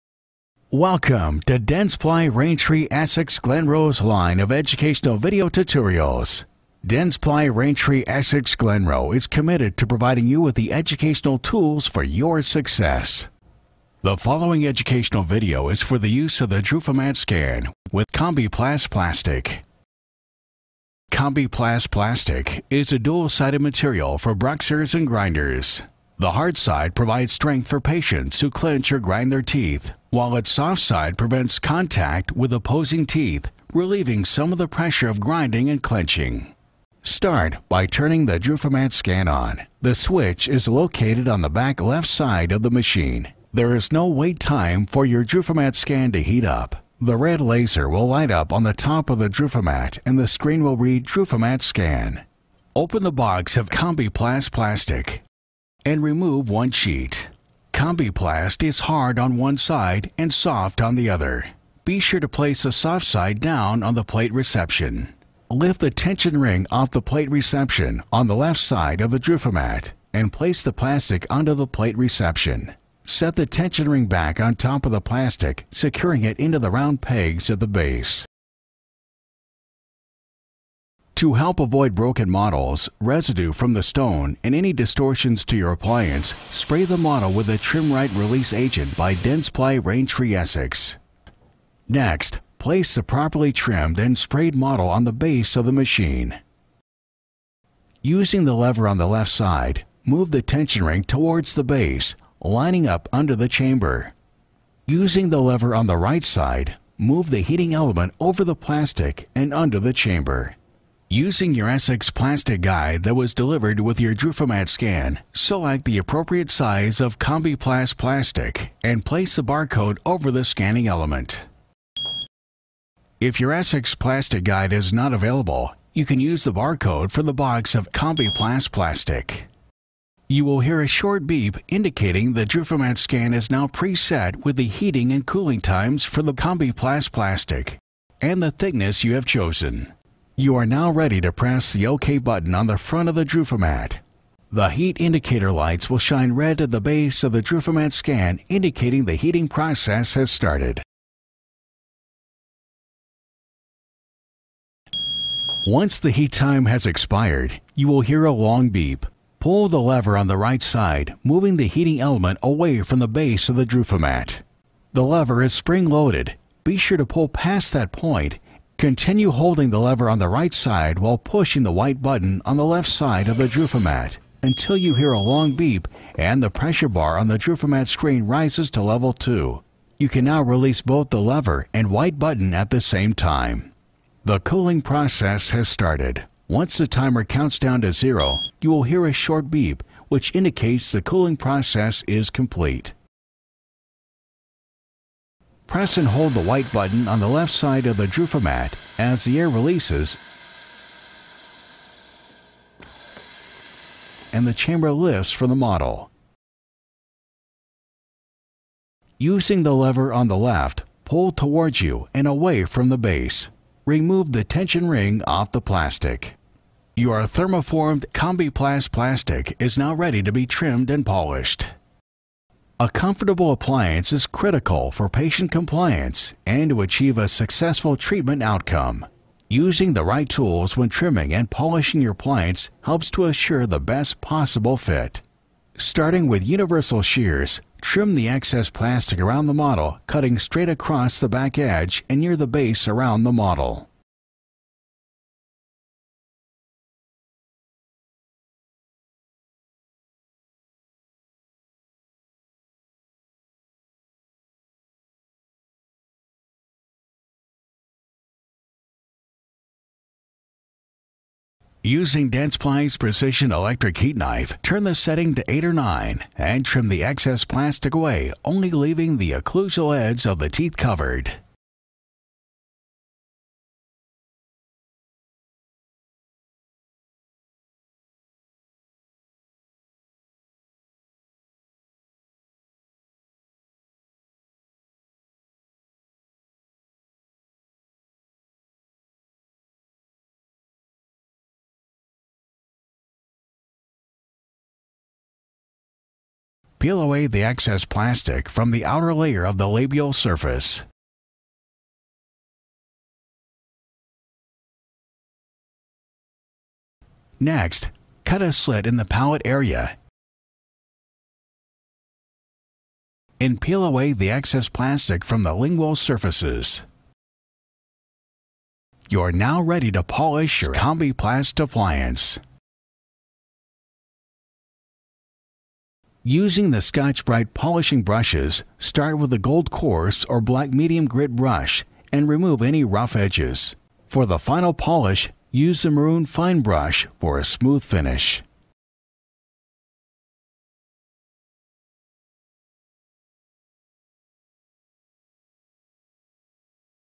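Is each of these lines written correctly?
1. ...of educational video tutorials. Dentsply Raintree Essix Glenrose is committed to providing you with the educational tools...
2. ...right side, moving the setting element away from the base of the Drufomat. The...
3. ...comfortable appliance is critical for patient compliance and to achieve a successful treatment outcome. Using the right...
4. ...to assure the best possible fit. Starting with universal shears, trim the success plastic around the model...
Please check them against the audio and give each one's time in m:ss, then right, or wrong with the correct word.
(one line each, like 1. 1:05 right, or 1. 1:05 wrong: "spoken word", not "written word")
1. 0:04 right
2. 2:40 wrong: "heating", not "setting"
3. 3:42 right
4. 3:53 wrong: "excess", not "success".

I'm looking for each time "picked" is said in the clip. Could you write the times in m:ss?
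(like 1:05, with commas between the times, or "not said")
not said.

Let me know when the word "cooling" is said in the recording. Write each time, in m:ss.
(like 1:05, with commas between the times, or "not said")
2:15, 3:04, 3:11.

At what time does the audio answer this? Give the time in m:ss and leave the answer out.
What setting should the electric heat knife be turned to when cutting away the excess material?
4:25.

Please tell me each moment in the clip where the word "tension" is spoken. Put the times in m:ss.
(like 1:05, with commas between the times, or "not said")
1:05, 1:13, 1:40, 3:34.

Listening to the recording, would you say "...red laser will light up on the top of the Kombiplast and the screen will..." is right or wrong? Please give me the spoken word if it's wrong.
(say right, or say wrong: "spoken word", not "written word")
wrong: "Drufomat", not "Kombiplast".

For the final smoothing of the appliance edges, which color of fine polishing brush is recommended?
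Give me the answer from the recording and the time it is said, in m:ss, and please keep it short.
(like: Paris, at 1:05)
Maroon, at 5:35.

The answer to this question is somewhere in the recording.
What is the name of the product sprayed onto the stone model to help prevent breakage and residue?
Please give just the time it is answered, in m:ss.
1:27.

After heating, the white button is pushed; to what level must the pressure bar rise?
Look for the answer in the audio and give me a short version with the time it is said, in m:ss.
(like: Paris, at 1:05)
2, at 2:58.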